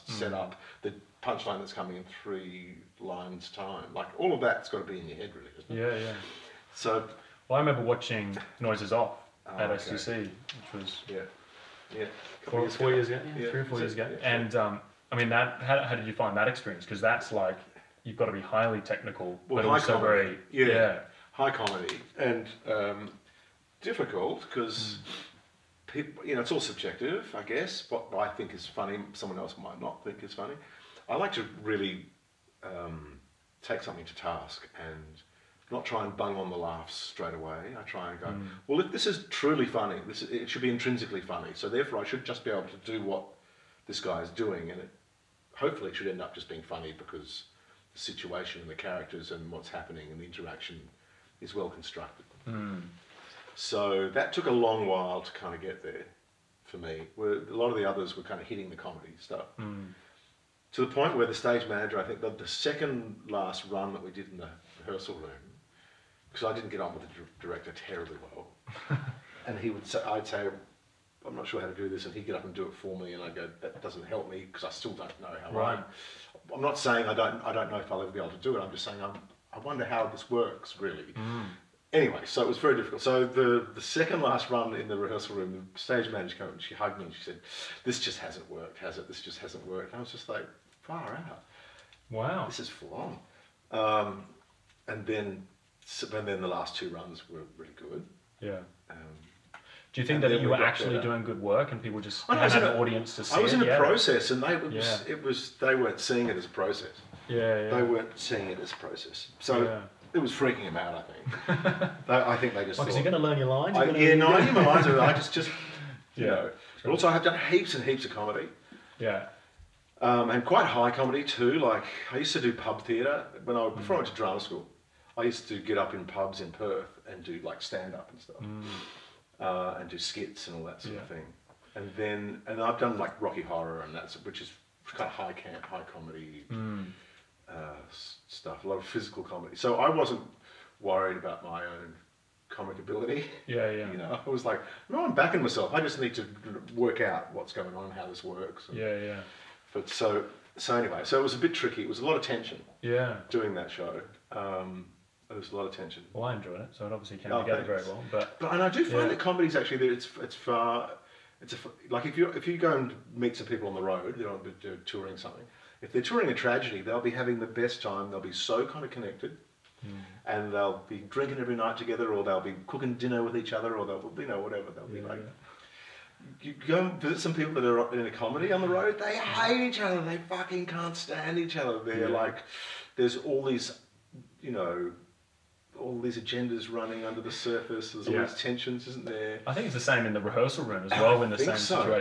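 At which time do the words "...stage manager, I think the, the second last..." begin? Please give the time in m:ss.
1:01.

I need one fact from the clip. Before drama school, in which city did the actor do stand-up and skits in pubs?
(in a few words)
Perth.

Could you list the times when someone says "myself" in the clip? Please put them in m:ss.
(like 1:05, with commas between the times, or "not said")
2:25.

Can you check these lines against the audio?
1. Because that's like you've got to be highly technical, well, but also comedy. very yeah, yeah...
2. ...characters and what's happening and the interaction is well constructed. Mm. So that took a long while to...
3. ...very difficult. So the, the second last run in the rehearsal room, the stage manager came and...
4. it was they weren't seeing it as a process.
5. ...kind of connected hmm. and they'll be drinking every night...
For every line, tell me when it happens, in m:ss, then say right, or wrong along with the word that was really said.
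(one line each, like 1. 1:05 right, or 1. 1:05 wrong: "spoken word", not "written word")
1. 0:16 right
2. 0:48 right
3. 1:22 right
4. 1:45 right
5. 2:48 right.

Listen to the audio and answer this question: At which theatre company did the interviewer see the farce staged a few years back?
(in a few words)
STC.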